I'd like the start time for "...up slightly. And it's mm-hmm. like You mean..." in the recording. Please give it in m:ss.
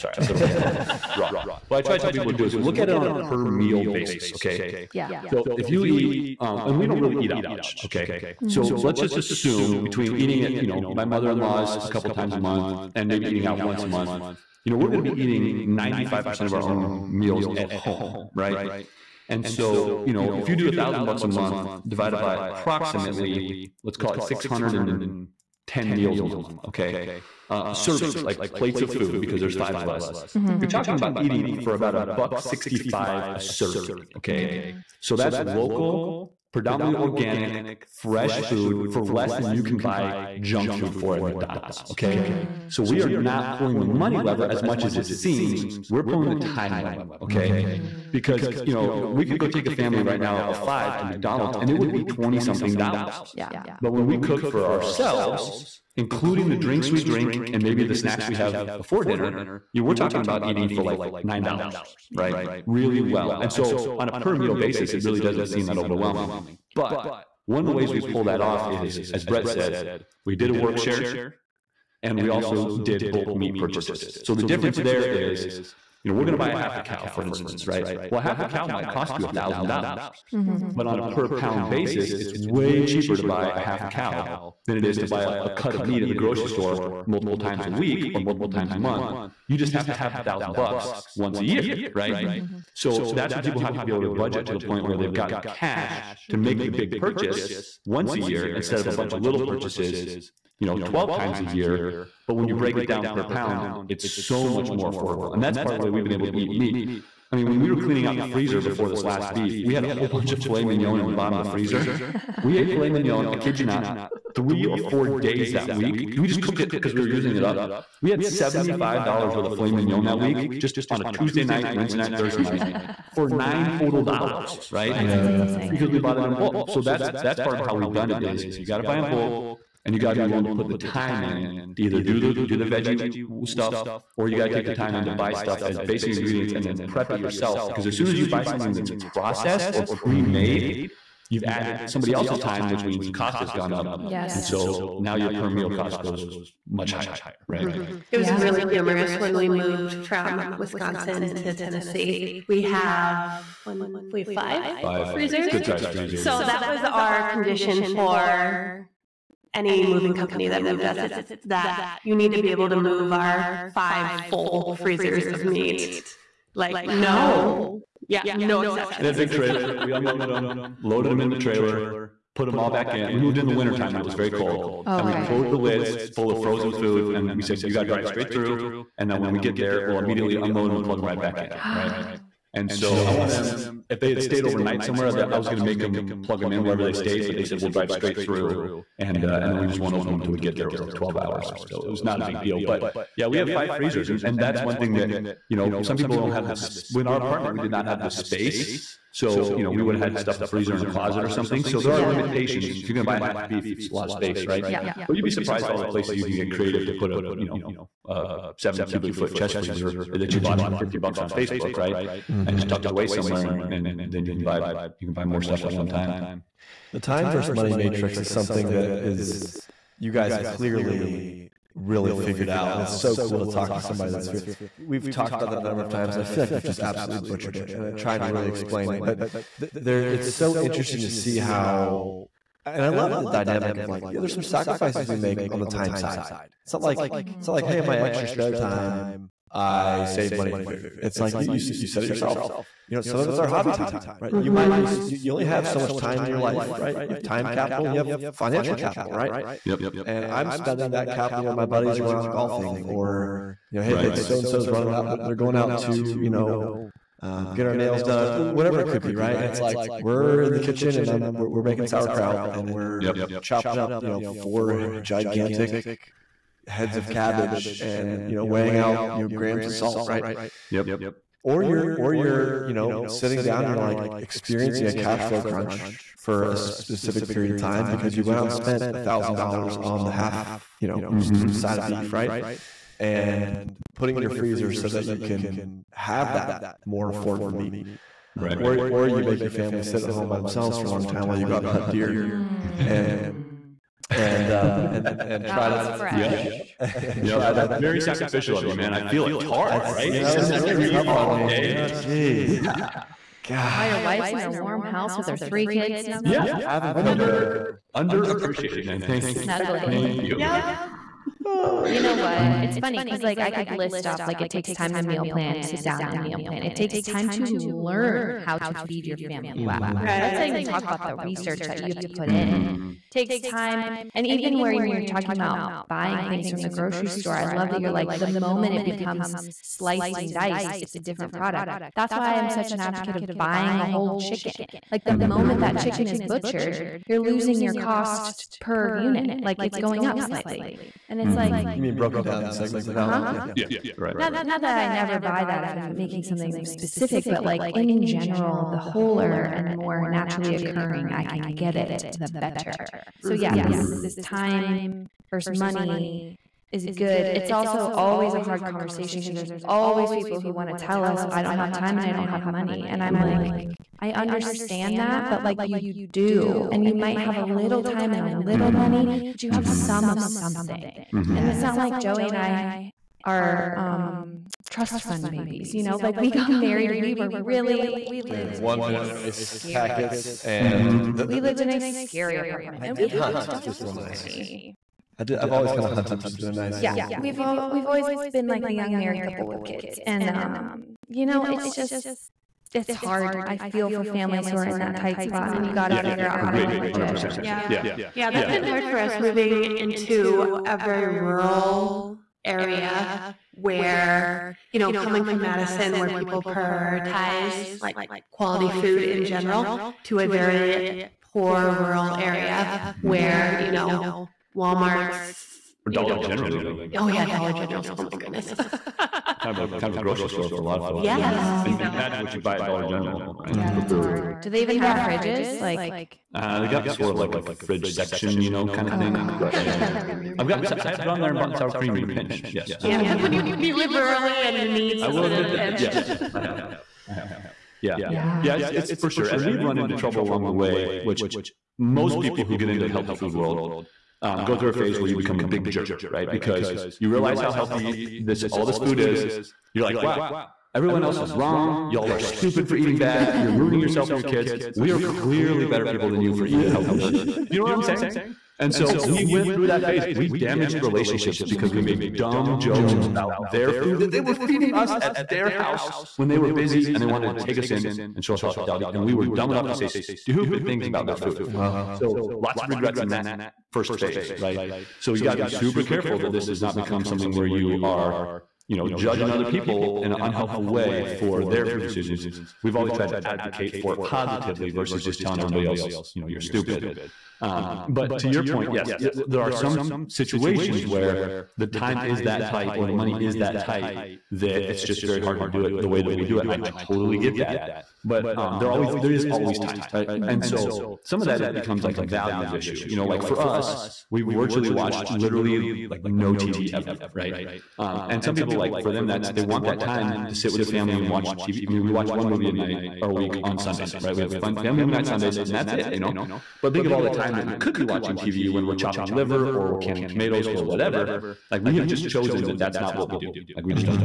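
5:40.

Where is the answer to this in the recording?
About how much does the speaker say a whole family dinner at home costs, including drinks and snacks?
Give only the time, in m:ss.
1:01.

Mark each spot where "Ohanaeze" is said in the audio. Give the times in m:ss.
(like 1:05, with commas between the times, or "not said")
not said.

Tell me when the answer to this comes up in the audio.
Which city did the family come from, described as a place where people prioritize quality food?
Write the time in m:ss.
6:45.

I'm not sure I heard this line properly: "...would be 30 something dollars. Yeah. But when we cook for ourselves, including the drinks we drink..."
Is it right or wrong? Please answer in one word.
wrong.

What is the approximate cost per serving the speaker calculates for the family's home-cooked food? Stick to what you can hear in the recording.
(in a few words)
$1.65.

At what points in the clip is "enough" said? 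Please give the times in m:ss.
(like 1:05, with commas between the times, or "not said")
7:49.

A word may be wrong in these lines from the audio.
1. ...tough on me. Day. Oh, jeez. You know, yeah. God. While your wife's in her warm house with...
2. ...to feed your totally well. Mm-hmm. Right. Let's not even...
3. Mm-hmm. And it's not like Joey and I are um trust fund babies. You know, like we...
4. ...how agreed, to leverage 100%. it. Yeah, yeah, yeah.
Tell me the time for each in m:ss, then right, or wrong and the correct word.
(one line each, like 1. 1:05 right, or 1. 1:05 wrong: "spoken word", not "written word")
1. 5:00 right
2. 5:18 wrong: "family", not "totally"
3. 6:11 right
4. 6:36 right.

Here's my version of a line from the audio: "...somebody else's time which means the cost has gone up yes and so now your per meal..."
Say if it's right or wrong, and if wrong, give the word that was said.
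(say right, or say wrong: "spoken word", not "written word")
right.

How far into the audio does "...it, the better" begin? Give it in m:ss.
5:51.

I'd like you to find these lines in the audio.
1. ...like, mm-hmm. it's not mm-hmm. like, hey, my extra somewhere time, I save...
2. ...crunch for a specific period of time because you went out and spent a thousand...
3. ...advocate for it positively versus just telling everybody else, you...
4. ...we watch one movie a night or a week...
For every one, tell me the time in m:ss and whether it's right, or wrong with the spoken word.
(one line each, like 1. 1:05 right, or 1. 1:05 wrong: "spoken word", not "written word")
1. 3:56 wrong: "spare", not "somewhere"
2. 4:35 right
3. 8:03 right
4. 8:31 right.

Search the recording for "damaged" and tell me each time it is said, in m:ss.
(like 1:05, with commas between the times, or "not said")
7:40.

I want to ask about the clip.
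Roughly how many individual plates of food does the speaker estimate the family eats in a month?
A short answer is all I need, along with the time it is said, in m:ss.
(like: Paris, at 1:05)
610, at 0:24.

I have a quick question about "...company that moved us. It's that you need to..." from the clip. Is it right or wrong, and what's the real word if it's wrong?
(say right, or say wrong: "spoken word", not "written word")
right.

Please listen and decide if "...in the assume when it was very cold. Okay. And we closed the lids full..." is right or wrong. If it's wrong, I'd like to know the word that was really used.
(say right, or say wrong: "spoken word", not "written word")
wrong: "wintertime", not "assume".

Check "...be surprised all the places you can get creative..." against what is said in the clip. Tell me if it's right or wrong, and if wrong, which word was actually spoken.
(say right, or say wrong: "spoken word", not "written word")
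right.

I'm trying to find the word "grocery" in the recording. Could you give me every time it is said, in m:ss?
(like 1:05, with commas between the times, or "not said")
1:26, 5:26, 7:00.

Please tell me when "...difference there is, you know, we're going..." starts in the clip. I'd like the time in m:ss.
1:14.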